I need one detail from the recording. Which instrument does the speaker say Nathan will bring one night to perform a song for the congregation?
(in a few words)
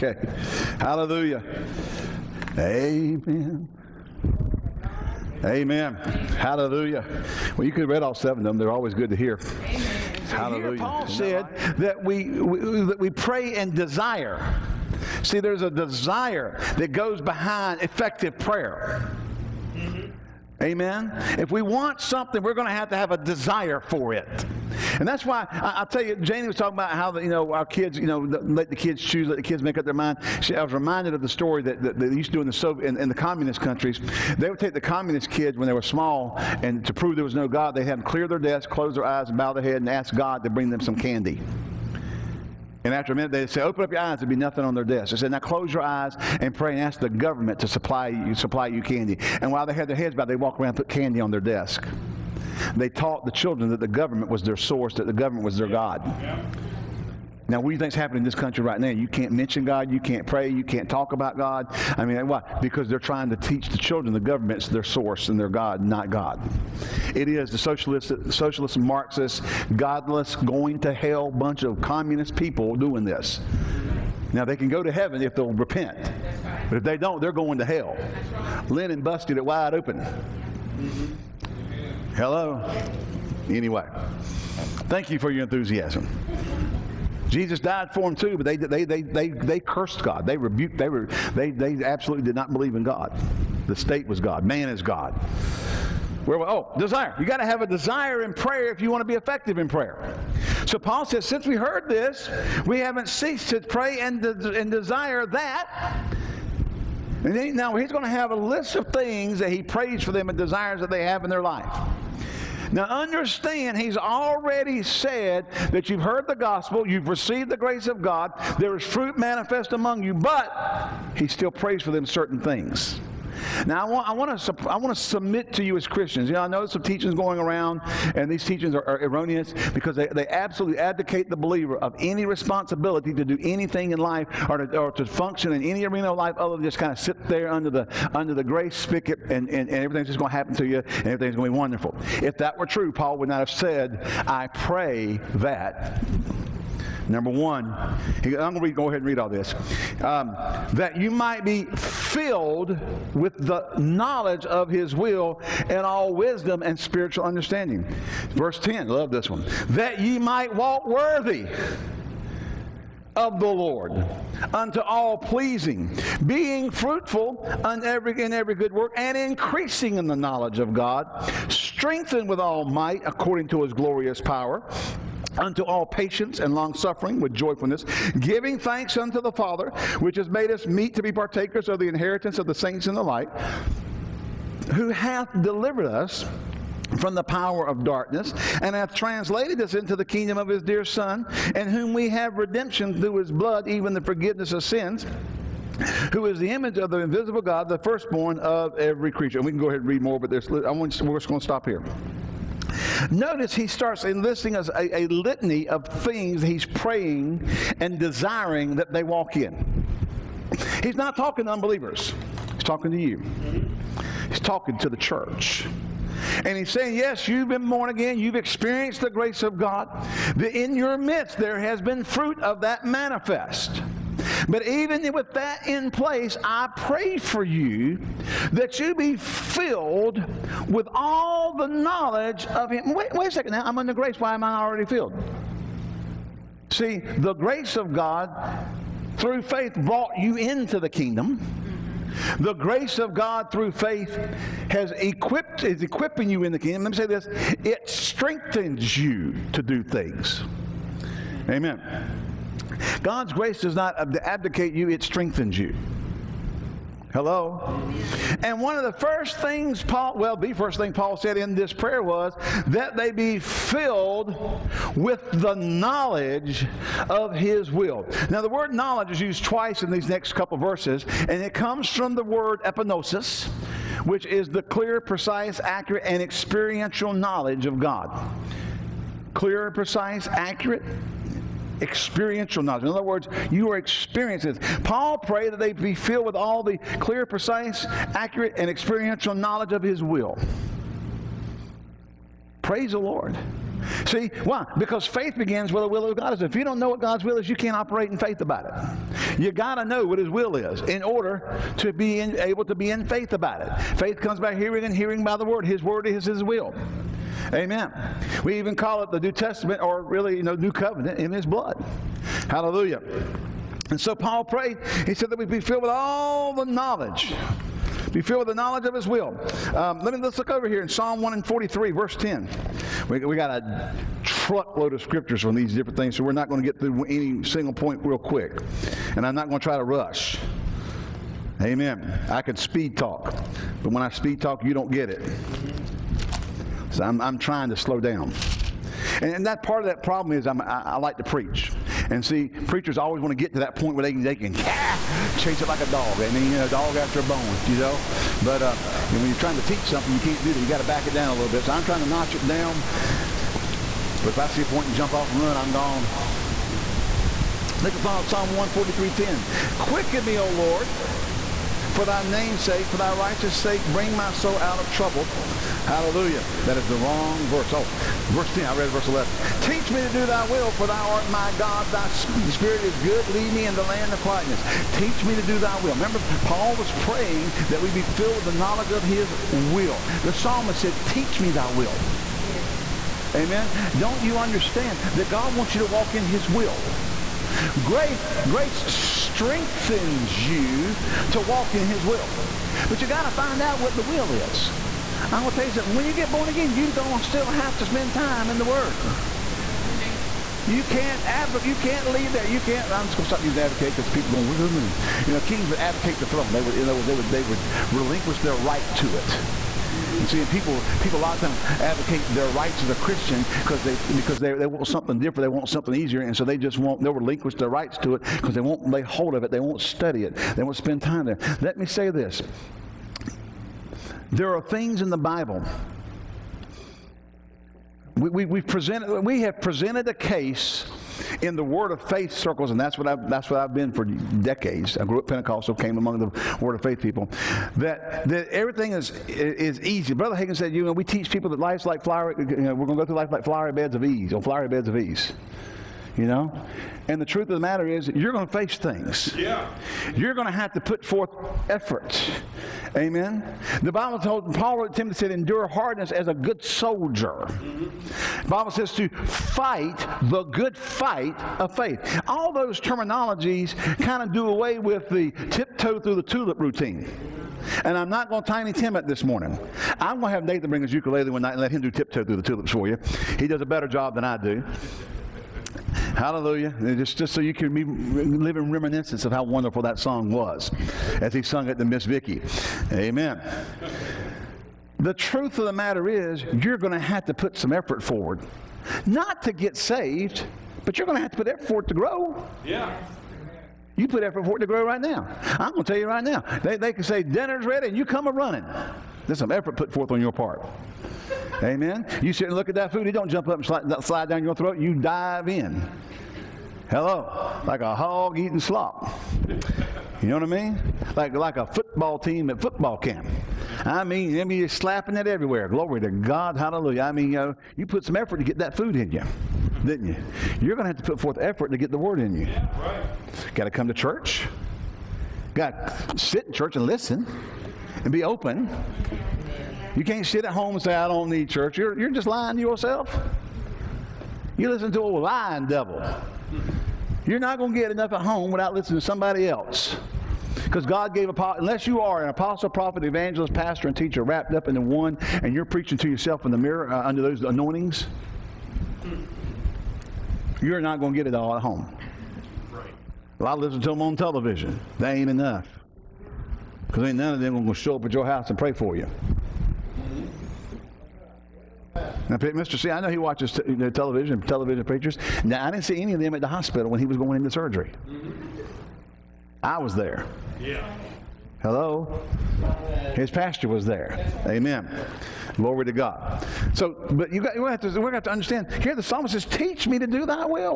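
ukulele.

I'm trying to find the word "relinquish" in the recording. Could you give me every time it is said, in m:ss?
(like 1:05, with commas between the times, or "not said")
6:47, 6:57.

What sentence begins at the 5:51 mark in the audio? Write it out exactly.
So I'm trying to notch it down.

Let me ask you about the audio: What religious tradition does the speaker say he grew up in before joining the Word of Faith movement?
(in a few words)
Pentecostal.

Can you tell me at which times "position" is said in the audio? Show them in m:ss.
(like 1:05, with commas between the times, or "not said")
not said.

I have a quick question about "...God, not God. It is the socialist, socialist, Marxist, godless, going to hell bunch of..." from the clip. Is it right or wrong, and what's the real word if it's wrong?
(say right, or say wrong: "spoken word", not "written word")
right.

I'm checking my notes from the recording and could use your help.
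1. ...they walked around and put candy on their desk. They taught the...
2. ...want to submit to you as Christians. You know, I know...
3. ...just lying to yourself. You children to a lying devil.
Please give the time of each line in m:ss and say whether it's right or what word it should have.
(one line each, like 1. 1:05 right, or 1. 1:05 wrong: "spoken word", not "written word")
1. 0:50 right
2. 2:04 right
3. 8:52 wrong: "listen", not "children".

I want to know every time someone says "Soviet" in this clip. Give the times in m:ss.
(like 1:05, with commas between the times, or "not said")
0:32.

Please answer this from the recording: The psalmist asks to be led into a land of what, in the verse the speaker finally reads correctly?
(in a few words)
quietness.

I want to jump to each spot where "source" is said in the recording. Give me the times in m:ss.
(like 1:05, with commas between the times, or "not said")
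0:54, 1:04.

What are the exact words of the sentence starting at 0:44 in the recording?
There'd be nothing on their desk.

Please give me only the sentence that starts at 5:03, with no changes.
Faith comes by hearing, and hearing by the Word.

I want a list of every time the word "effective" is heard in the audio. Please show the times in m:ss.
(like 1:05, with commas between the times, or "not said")
0:17, 1:39.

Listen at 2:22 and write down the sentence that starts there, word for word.
If that were true, Paul would not have said, I pray that.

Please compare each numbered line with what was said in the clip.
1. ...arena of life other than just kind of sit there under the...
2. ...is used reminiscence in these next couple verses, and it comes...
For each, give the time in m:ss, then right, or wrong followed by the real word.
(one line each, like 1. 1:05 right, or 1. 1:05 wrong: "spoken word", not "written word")
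1. 2:15 right
2. 4:29 wrong: "twice", not "reminiscence".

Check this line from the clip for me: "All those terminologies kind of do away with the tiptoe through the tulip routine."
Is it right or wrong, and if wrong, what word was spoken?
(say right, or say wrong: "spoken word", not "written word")
right.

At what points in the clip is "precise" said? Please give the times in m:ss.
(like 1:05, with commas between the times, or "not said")
4:35, 4:39, 4:47.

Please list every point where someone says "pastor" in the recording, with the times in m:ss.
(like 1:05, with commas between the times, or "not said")
9:03, 9:33.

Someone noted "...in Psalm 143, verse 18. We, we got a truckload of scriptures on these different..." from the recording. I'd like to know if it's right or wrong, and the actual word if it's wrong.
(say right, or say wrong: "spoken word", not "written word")
wrong: "10", not "18".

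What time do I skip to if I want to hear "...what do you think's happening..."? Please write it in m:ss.
0:57.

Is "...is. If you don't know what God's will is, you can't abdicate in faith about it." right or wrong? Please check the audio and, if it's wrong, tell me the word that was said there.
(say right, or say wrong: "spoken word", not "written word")
wrong: "operate", not "abdicate".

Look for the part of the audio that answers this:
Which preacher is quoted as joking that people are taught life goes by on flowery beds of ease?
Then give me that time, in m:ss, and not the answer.
7:20.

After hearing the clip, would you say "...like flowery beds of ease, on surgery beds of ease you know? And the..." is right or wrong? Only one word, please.
wrong.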